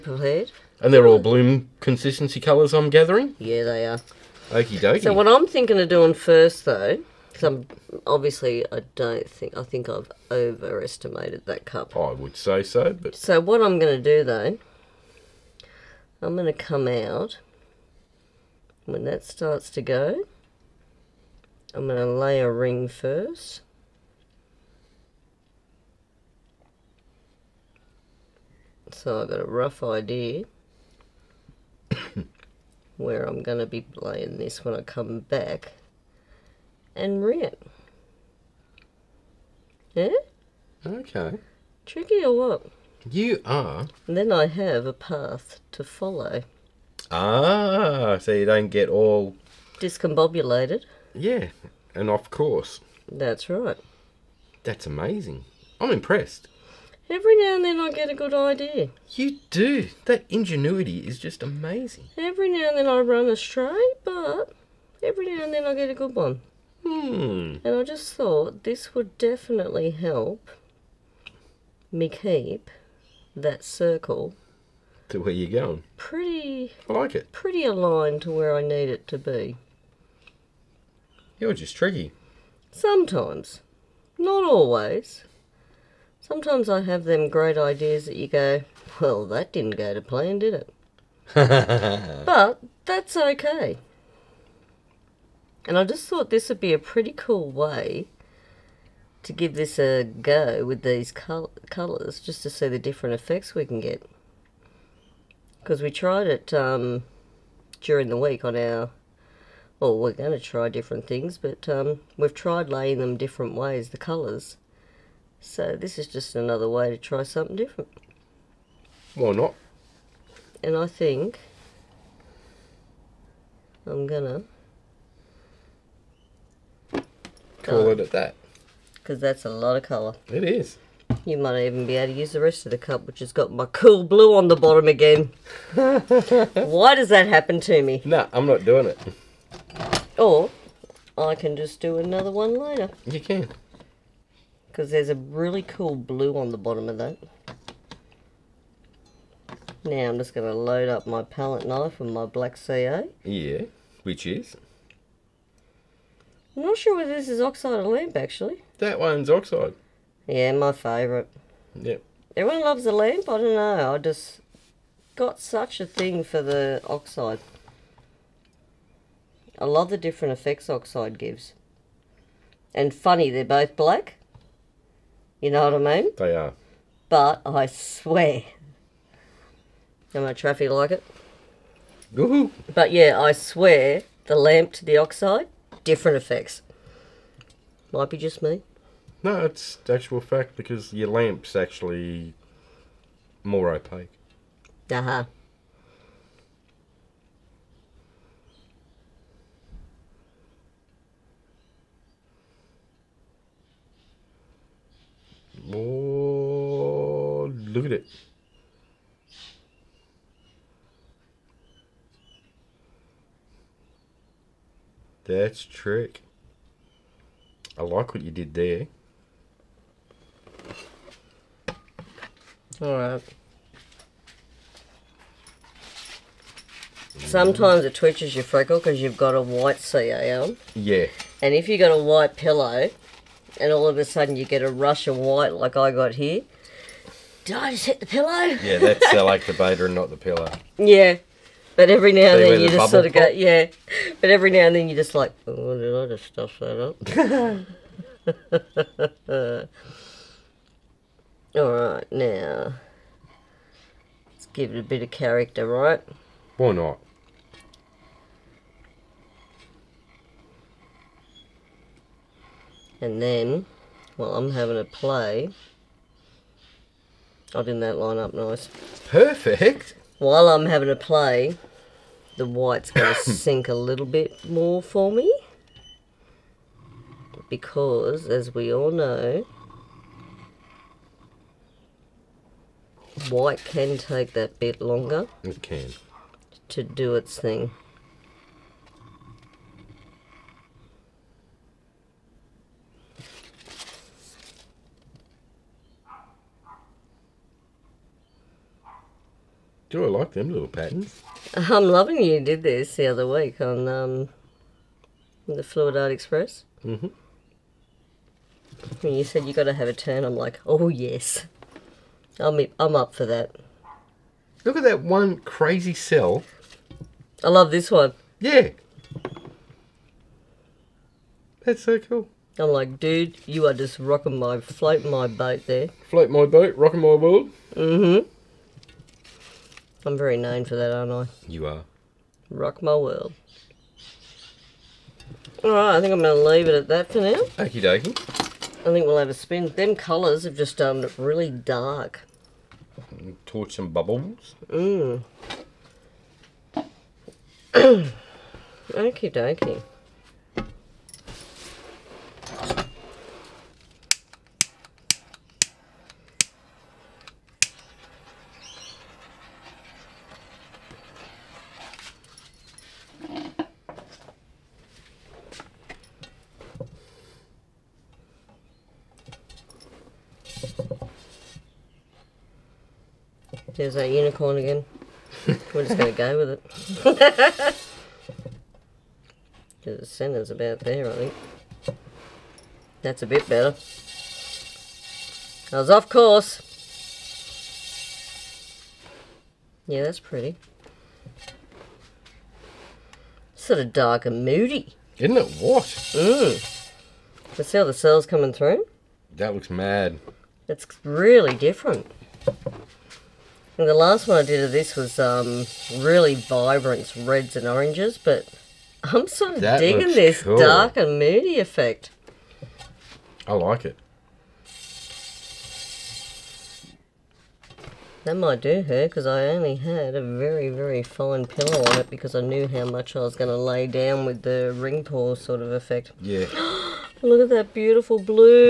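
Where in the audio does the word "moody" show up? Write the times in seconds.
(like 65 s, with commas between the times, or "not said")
394 s, 411 s.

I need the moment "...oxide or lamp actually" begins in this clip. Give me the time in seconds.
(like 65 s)
157 s.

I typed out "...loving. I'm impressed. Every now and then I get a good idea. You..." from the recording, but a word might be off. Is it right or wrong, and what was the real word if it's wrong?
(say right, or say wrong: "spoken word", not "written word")
wrong: "amazing", not "loving".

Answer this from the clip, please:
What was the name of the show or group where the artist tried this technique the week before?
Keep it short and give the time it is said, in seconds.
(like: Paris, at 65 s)
Fluid Art Express, at 305 s.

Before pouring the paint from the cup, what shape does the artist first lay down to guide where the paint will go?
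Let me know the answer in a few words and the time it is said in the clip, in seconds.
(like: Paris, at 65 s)
A ring, at 22 s.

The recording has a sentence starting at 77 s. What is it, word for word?
Pretty aligned to where I need it to be.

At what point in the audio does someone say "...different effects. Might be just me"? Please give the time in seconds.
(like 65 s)
185 s.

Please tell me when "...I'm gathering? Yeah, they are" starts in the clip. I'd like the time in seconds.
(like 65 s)
2 s.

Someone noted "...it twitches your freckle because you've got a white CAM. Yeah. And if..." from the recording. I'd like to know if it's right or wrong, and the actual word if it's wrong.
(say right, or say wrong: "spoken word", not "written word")
right.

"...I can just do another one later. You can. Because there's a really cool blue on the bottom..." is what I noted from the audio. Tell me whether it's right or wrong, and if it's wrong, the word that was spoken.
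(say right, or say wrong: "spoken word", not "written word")
right.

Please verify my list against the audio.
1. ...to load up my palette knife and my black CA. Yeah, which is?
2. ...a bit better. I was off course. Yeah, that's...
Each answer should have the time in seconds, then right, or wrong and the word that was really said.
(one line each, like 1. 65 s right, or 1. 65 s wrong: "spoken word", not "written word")
1. 150 s right
2. 383 s right.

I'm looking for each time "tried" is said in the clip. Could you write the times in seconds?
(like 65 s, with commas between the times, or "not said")
105 s, 112 s.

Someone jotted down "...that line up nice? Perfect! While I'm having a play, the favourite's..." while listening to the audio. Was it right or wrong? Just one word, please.
wrong.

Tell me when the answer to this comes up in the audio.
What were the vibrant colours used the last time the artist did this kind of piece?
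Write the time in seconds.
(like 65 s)
407 s.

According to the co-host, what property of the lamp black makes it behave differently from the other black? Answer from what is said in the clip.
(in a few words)
More opaque.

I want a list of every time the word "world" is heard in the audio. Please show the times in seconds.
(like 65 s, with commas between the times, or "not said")
327 s, 332 s.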